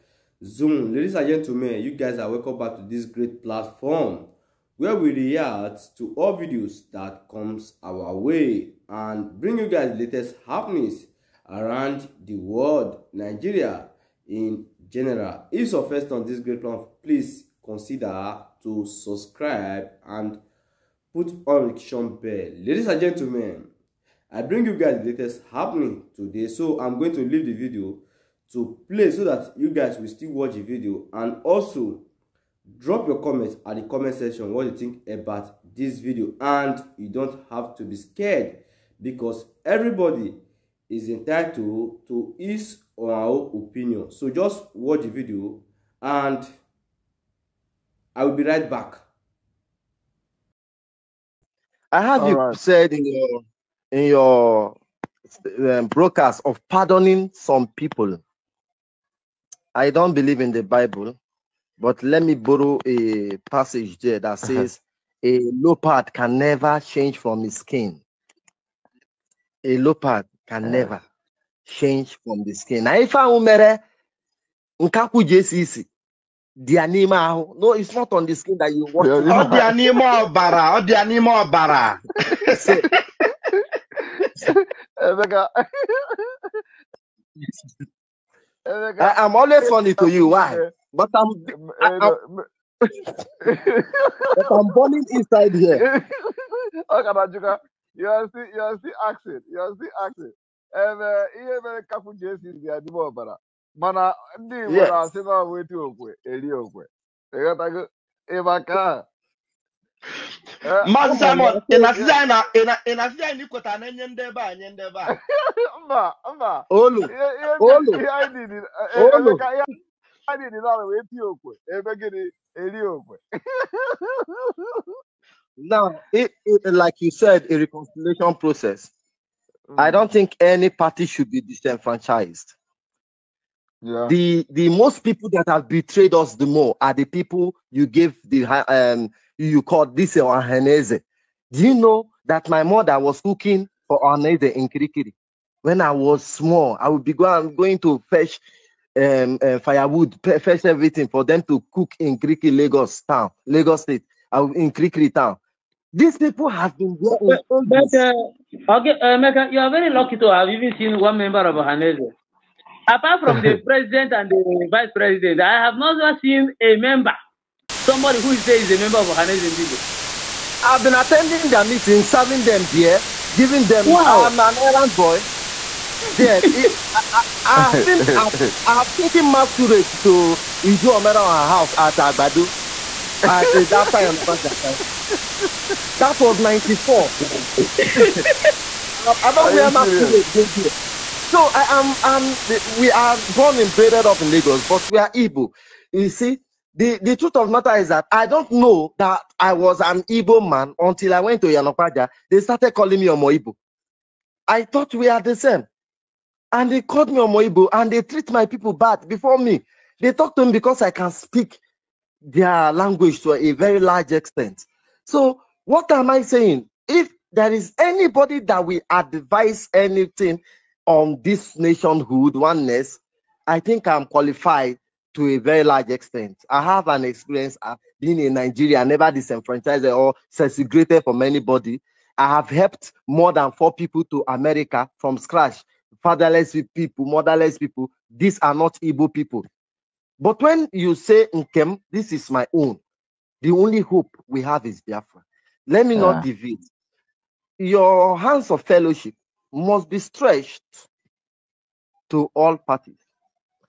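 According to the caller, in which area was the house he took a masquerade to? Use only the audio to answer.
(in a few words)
Agbado.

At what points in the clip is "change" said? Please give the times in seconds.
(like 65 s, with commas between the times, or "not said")
66 s, 71 s.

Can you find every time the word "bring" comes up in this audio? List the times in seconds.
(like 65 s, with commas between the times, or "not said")
9 s, 24 s.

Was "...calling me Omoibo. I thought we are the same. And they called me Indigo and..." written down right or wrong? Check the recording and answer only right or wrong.
wrong.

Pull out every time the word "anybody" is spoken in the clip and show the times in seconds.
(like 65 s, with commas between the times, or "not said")
217 s, 231 s.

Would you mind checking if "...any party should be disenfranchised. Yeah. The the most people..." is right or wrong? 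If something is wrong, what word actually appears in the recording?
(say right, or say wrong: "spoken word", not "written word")
right.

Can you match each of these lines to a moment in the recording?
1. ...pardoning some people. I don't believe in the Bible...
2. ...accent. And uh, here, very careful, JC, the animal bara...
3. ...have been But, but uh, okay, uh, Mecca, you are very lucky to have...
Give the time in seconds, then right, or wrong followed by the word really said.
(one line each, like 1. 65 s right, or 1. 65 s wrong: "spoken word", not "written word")
1. 56 s right
2. 100 s right
3. 156 s right.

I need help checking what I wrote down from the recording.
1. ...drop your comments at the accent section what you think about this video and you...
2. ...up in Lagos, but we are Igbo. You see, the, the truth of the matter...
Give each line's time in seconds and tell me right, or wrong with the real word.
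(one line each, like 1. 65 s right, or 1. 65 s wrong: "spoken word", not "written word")
1. 32 s wrong: "comment", not "accent"
2. 193 s right.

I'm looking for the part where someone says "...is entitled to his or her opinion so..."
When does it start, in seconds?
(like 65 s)
40 s.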